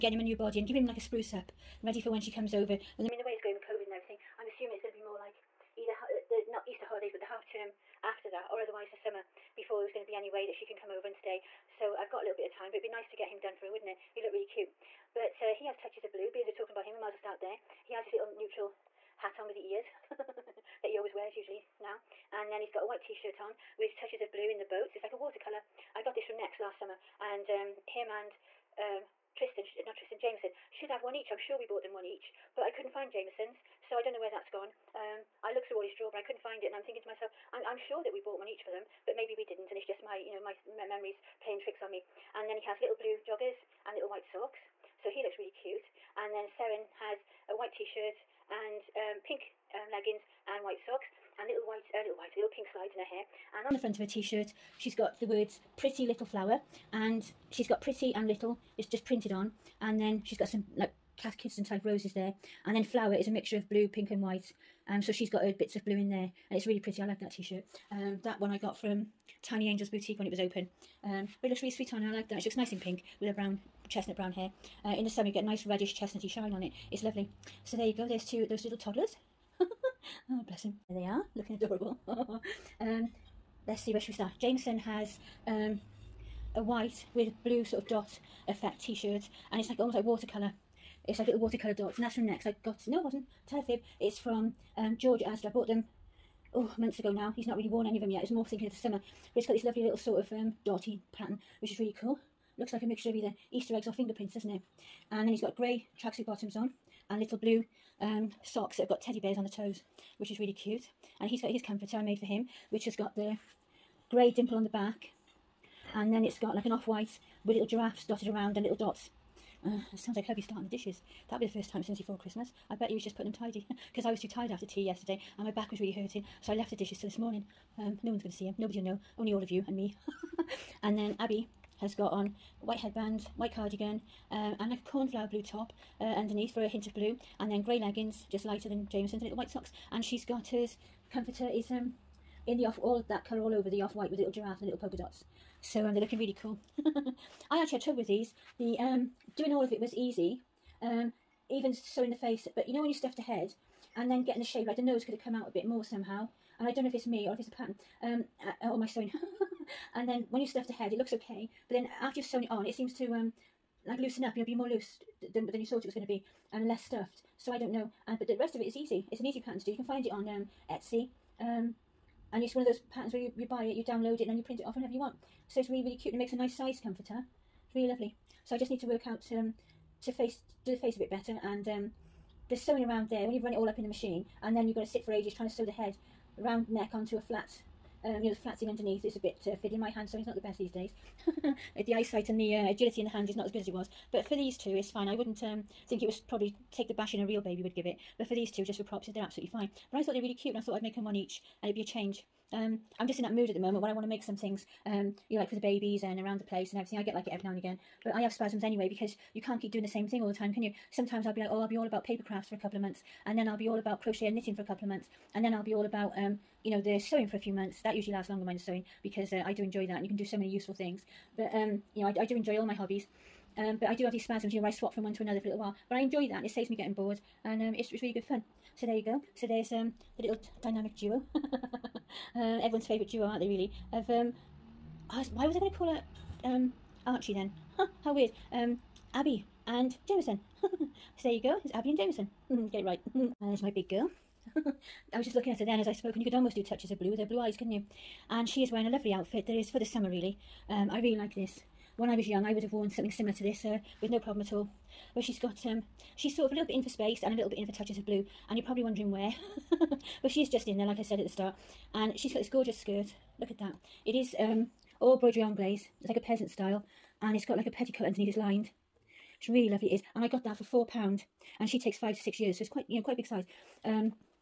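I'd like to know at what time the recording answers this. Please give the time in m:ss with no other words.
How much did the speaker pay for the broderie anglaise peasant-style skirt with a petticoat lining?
4:30.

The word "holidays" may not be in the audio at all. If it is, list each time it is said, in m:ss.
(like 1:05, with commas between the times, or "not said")
0:06.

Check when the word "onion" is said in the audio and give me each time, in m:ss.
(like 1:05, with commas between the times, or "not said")
not said.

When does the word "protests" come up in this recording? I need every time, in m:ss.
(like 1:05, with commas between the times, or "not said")
not said.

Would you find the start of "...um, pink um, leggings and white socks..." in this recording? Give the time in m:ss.
0:48.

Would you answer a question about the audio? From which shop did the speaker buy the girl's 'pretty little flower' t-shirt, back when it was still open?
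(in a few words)
Tiny Angels Boutique.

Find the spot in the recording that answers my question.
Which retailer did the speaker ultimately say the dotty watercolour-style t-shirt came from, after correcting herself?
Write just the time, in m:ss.
1:34.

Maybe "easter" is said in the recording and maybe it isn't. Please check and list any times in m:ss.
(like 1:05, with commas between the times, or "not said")
0:06, 1:43.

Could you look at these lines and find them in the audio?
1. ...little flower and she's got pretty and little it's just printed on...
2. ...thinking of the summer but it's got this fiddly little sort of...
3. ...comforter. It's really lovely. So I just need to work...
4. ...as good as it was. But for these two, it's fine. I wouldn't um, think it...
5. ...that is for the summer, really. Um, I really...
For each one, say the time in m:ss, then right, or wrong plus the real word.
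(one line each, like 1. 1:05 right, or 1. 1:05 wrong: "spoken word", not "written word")
1. 0:56 right
2. 1:38 wrong: "lovely", not "fiddly"
3. 2:56 right
4. 3:13 right
5. 4:09 right.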